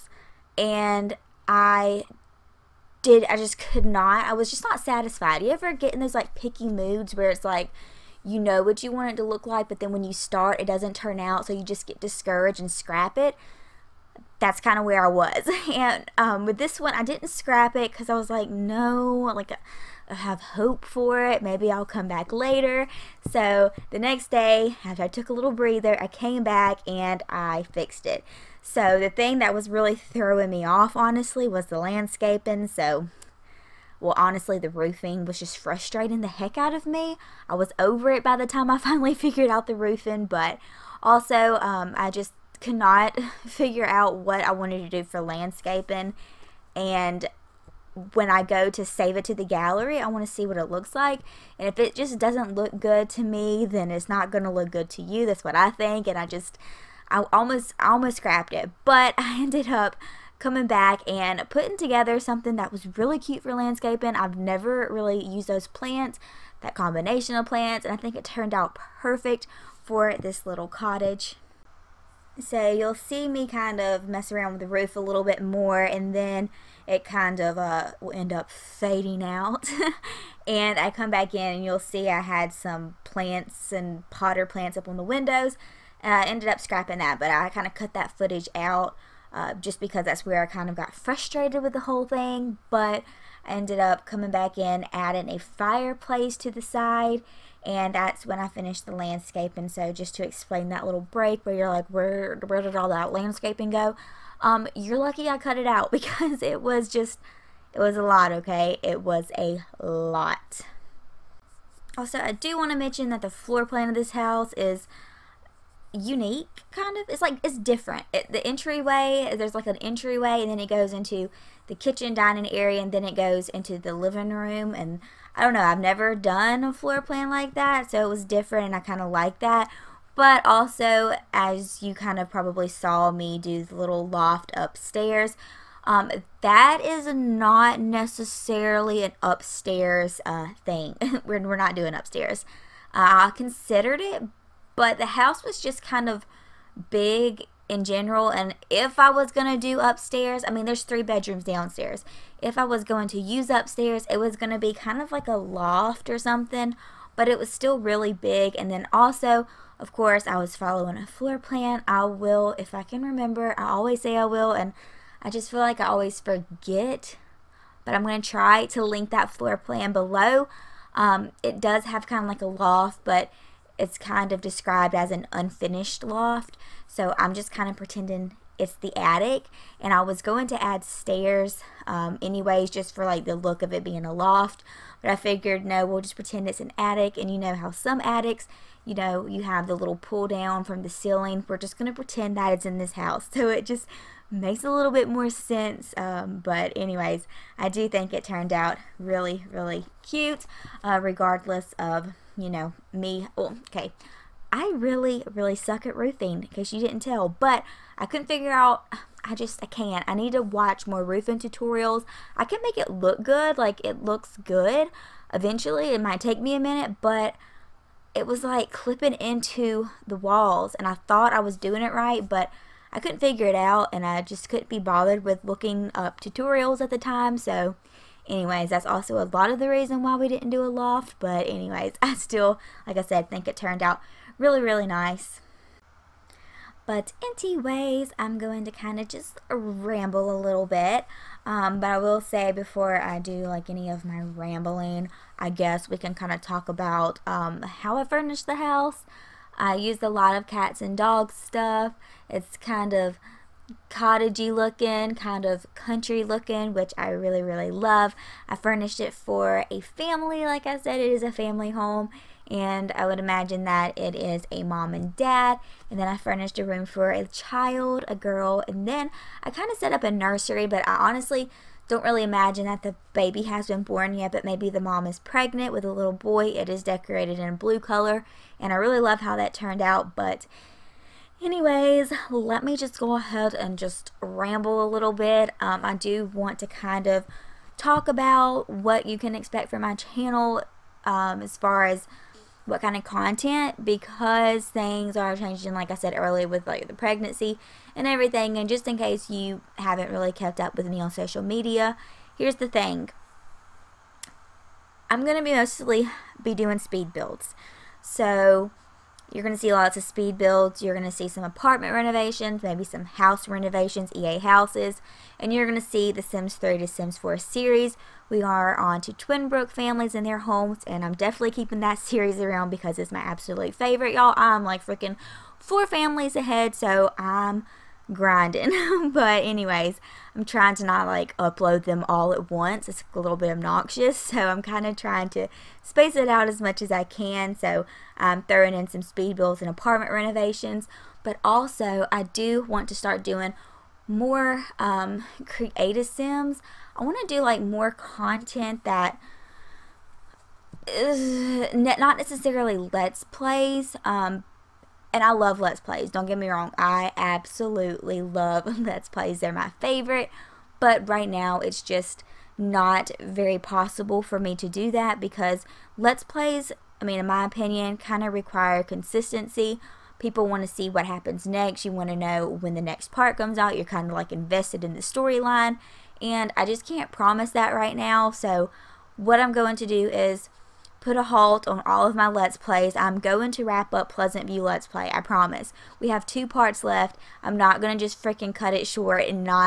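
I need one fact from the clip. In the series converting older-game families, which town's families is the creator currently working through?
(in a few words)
Twinbrook.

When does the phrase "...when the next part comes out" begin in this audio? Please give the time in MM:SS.
06:12.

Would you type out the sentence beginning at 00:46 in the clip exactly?
And when I go to save it to the gallery, I want to see what it looks like.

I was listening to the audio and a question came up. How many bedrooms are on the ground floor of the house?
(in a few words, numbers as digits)
3.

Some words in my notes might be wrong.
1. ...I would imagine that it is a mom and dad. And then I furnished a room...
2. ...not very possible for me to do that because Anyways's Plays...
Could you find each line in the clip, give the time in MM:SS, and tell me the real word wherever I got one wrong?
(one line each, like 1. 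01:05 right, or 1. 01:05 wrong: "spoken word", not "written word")
1. 04:22 right
2. 06:02 wrong: "Let", not "Anyways".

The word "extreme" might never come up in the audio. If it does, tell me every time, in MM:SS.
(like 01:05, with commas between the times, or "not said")
not said.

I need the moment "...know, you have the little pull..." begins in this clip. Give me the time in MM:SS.
03:08.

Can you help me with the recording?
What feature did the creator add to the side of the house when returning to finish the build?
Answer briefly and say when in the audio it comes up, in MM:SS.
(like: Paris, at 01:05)
fireplace, at 01:34.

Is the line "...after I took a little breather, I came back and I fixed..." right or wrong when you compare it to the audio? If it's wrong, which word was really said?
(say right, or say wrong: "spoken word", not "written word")
right.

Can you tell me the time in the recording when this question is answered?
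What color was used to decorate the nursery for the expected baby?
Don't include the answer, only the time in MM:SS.
04:37.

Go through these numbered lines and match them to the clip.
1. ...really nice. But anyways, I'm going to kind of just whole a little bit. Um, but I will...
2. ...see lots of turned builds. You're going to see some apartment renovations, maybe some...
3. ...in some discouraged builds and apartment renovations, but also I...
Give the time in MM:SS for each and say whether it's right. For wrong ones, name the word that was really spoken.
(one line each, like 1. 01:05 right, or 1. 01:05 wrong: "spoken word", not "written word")
1. 03:54 wrong: "ramble", not "whole"
2. 05:09 wrong: "speed", not "turned"
3. 05:38 wrong: "speed", not "discouraged".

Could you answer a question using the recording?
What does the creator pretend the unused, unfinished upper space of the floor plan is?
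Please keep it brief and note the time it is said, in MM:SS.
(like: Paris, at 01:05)
the attic, at 02:57.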